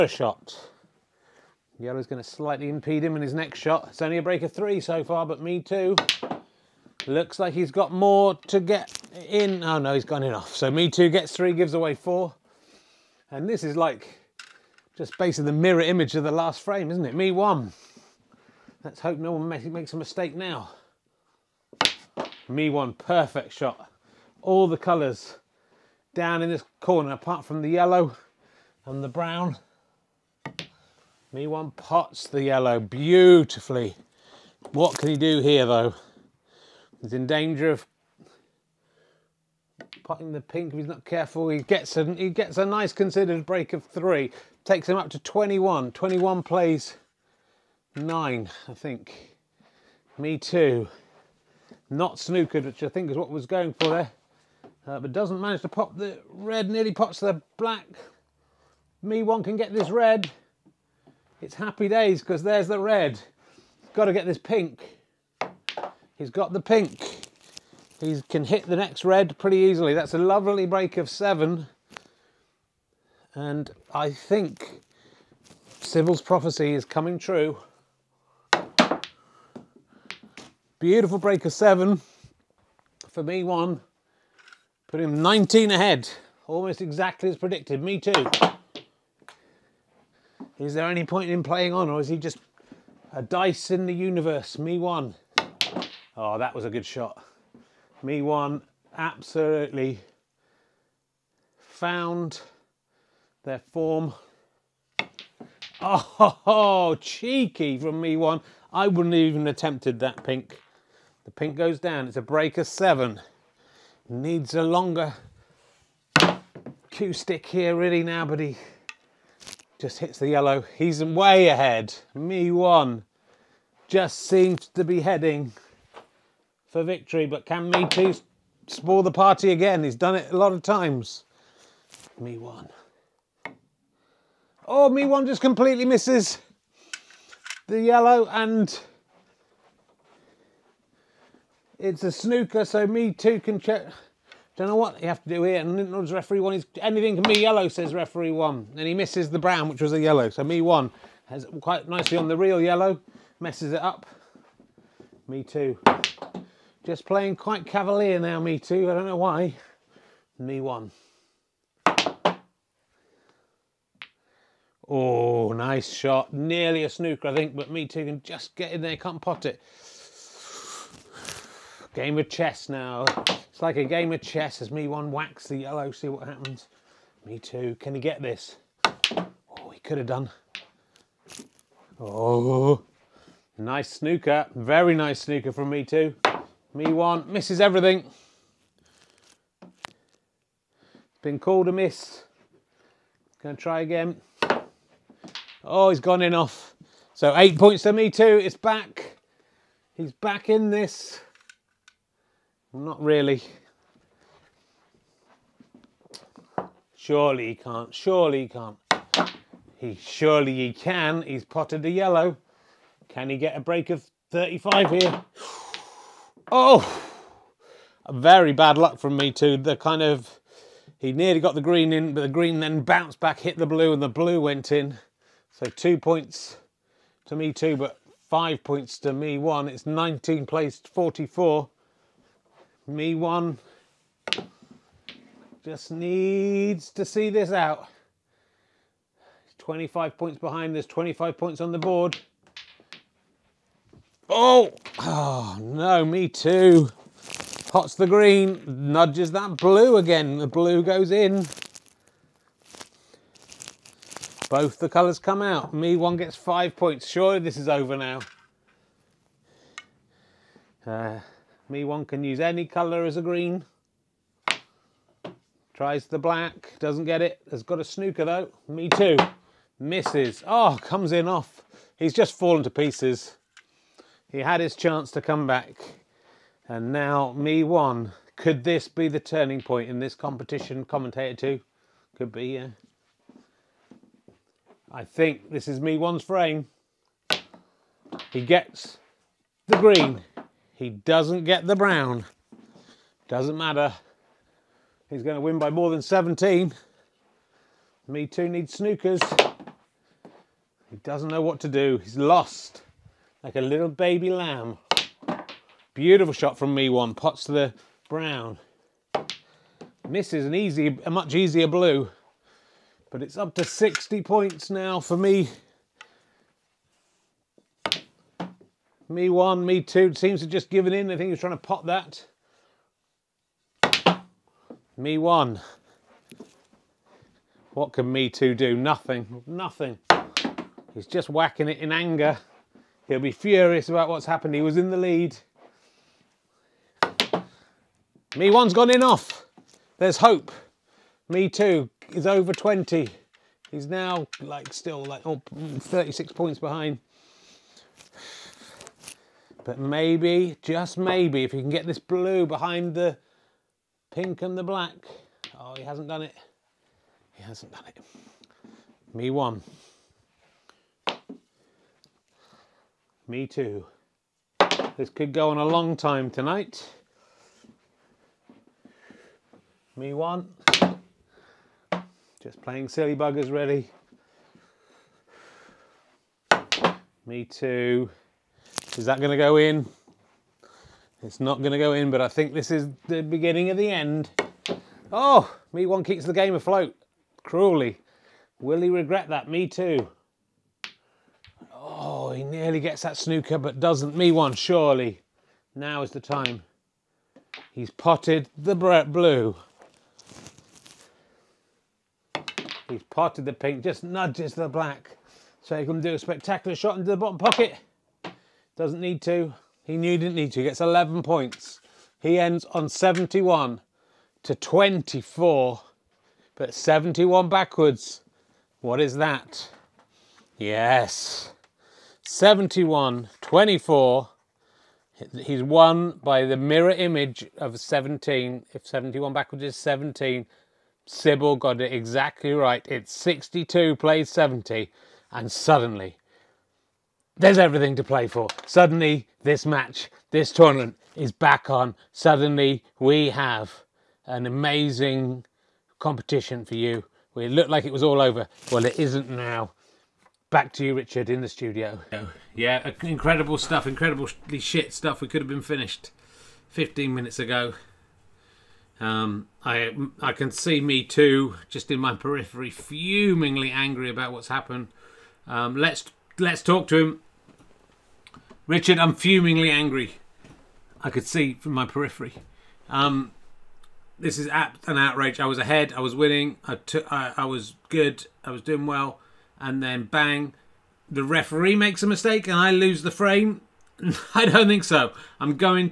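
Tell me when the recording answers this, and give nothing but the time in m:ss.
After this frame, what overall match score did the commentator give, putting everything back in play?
7:13.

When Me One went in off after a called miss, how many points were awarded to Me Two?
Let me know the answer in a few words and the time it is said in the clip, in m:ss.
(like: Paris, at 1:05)
8, at 3:17.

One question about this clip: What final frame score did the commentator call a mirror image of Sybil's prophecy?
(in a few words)
71 to 24.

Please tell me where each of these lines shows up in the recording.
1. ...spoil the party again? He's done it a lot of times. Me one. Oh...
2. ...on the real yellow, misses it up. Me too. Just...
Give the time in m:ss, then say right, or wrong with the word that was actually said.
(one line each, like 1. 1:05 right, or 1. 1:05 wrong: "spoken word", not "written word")
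1. 2:08 right
2. 2:32 wrong: "messes", not "misses".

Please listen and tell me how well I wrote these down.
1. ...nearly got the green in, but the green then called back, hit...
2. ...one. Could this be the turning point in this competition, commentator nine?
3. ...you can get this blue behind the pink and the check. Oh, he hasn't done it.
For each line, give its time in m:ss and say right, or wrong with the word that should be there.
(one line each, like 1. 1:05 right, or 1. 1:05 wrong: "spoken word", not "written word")
1. 3:41 wrong: "bounced", not "called"
2. 4:37 wrong: "two", not "nine"
3. 5:51 wrong: "black", not "check".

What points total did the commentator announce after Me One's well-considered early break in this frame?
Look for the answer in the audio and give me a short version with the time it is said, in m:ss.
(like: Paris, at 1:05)
21, at 0:44.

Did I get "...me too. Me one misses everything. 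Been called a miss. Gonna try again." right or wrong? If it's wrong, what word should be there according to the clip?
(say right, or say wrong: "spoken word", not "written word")
right.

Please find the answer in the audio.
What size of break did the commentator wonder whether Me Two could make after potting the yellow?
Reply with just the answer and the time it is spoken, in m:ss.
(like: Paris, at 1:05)
35, at 3:33.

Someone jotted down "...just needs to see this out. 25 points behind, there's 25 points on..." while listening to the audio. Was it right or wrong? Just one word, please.
right.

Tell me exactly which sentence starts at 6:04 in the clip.
This could go on a long time tonight.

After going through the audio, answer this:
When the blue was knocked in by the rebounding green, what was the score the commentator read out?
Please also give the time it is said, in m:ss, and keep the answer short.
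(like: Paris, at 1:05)
19 plays 44, at 3:49.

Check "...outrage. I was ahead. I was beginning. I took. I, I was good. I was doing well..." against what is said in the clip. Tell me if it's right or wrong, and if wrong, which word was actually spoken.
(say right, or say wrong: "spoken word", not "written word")
wrong: "winning", not "beginning".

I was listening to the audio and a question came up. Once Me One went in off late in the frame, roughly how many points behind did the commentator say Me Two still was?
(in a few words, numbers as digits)
36.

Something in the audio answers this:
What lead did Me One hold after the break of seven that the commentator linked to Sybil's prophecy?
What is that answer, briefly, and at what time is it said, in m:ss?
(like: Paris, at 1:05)
19 ahead, at 1:24.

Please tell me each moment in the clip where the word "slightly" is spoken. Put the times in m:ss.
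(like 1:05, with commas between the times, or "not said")
0:02.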